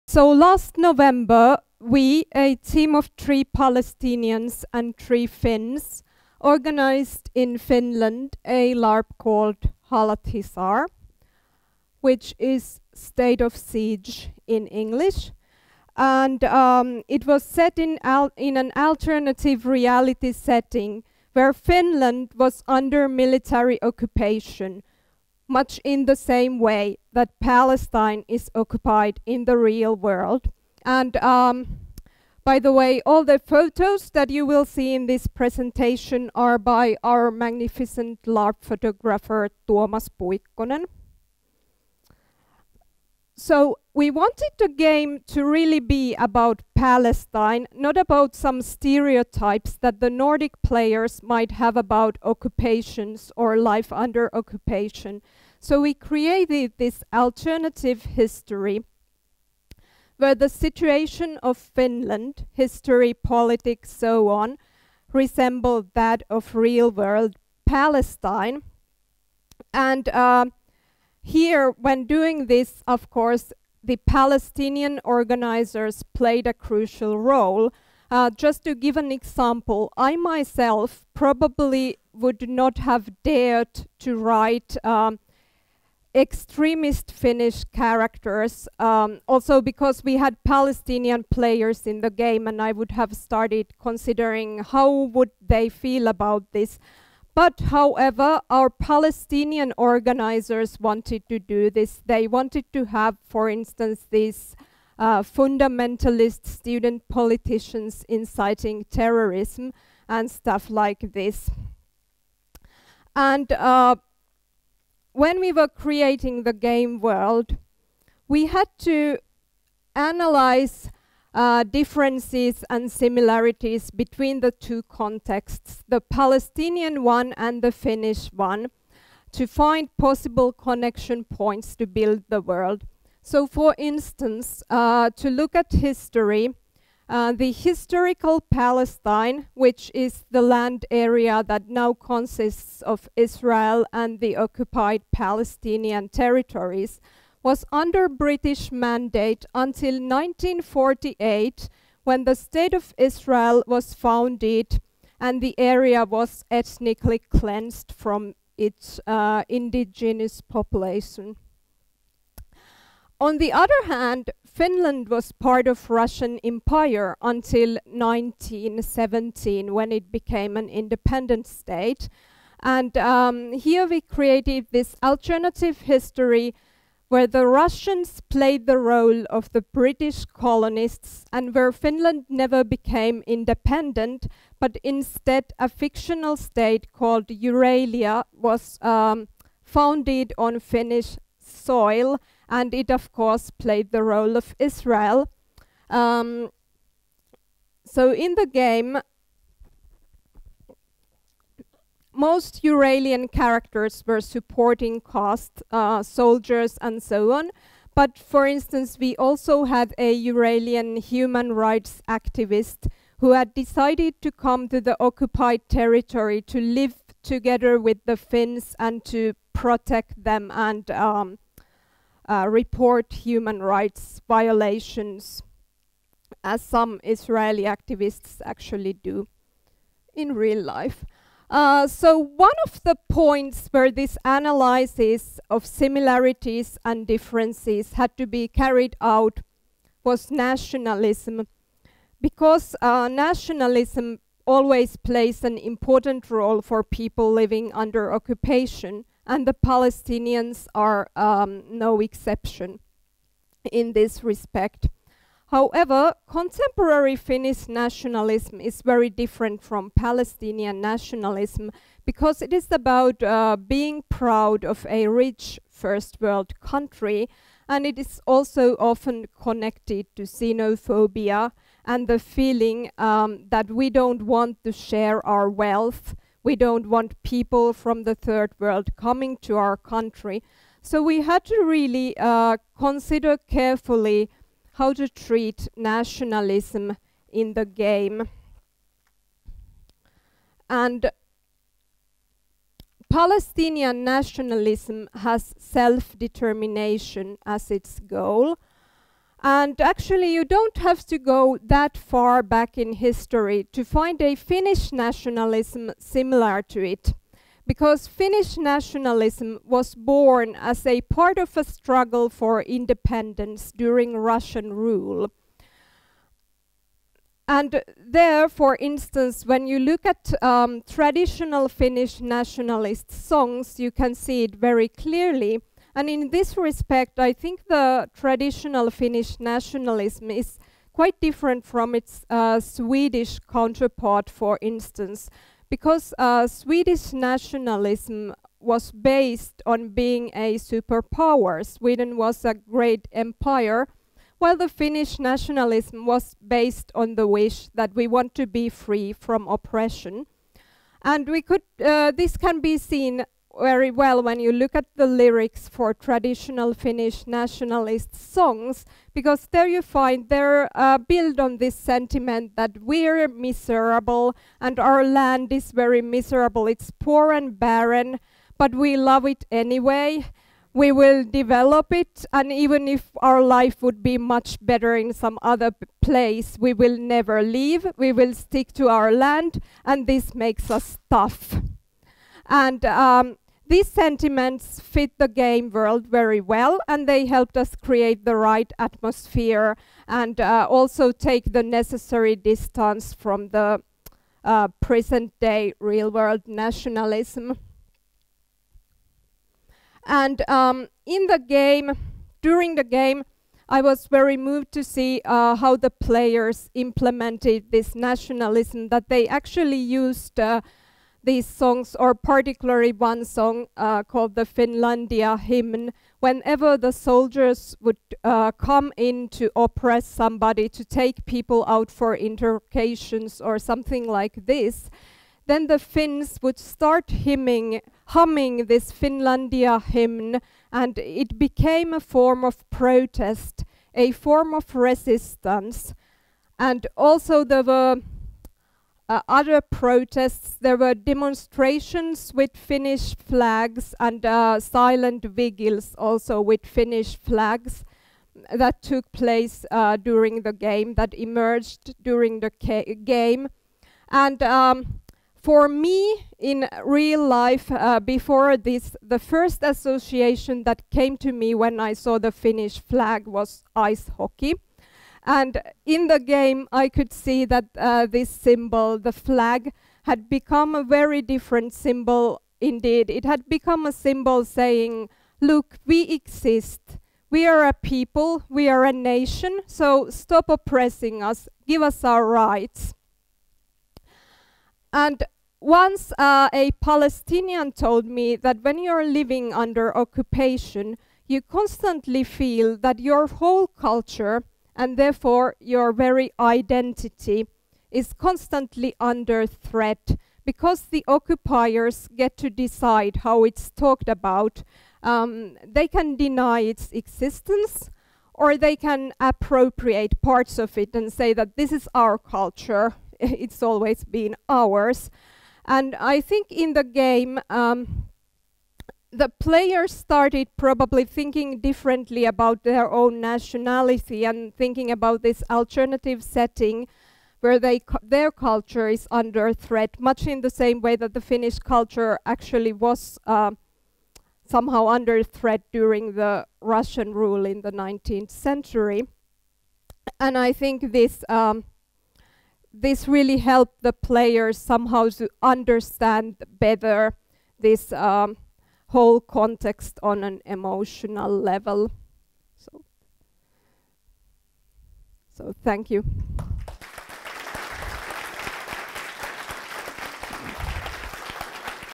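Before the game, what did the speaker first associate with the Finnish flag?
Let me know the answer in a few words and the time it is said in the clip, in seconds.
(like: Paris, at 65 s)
Ice hockey, at 463 s.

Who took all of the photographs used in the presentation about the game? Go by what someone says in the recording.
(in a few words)
Tuomas Puikkonen.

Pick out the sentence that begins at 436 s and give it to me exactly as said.
And also there were uh, other protests.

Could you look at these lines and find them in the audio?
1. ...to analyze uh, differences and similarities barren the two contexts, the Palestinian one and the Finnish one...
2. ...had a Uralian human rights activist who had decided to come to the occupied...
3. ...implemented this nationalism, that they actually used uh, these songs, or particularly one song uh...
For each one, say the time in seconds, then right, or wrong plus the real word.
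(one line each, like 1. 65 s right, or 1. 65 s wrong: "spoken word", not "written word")
1. 118 s wrong: "between", not "barren"
2. 209 s right
3. 406 s right.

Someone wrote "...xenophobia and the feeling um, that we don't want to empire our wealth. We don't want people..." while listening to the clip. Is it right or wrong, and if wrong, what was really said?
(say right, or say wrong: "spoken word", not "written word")
wrong: "share", not "empire".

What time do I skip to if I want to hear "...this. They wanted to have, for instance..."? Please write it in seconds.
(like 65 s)
101 s.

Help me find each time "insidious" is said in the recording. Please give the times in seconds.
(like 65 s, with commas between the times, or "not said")
not said.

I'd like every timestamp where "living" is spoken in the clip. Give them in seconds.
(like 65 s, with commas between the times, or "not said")
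247 s, 489 s.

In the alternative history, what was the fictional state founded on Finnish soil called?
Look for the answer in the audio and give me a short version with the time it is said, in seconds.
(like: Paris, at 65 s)
Euralia, at 187 s.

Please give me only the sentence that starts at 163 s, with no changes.
On the other hand, Finland was part of Russian Empire until 1917 when it became an independent state.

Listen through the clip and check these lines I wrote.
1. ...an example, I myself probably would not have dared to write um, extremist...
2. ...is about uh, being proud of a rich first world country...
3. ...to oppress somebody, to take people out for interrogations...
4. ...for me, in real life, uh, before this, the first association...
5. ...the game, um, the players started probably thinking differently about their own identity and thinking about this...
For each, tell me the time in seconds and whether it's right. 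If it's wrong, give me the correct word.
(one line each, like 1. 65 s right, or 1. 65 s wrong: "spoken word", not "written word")
1. 78 s right
2. 262 s right
3. 419 s right
4. 455 s right
5. 516 s wrong: "nationality", not "identity".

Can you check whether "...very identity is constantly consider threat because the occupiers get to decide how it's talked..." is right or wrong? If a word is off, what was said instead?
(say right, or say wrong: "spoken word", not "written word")
wrong: "under", not "consider".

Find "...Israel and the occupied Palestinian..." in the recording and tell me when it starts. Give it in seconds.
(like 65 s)
143 s.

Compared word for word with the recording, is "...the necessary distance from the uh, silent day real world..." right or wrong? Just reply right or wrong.
wrong.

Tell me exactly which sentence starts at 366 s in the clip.
It's poor and barren, but we love it anyway.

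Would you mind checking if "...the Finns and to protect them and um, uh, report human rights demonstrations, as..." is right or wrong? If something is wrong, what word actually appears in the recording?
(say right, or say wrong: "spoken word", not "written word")
wrong: "violations", not "demonstrations".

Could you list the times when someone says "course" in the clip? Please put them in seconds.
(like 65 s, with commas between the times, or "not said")
73 s, 193 s.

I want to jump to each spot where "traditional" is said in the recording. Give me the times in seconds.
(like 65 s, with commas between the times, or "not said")
320 s, 328 s, 355 s.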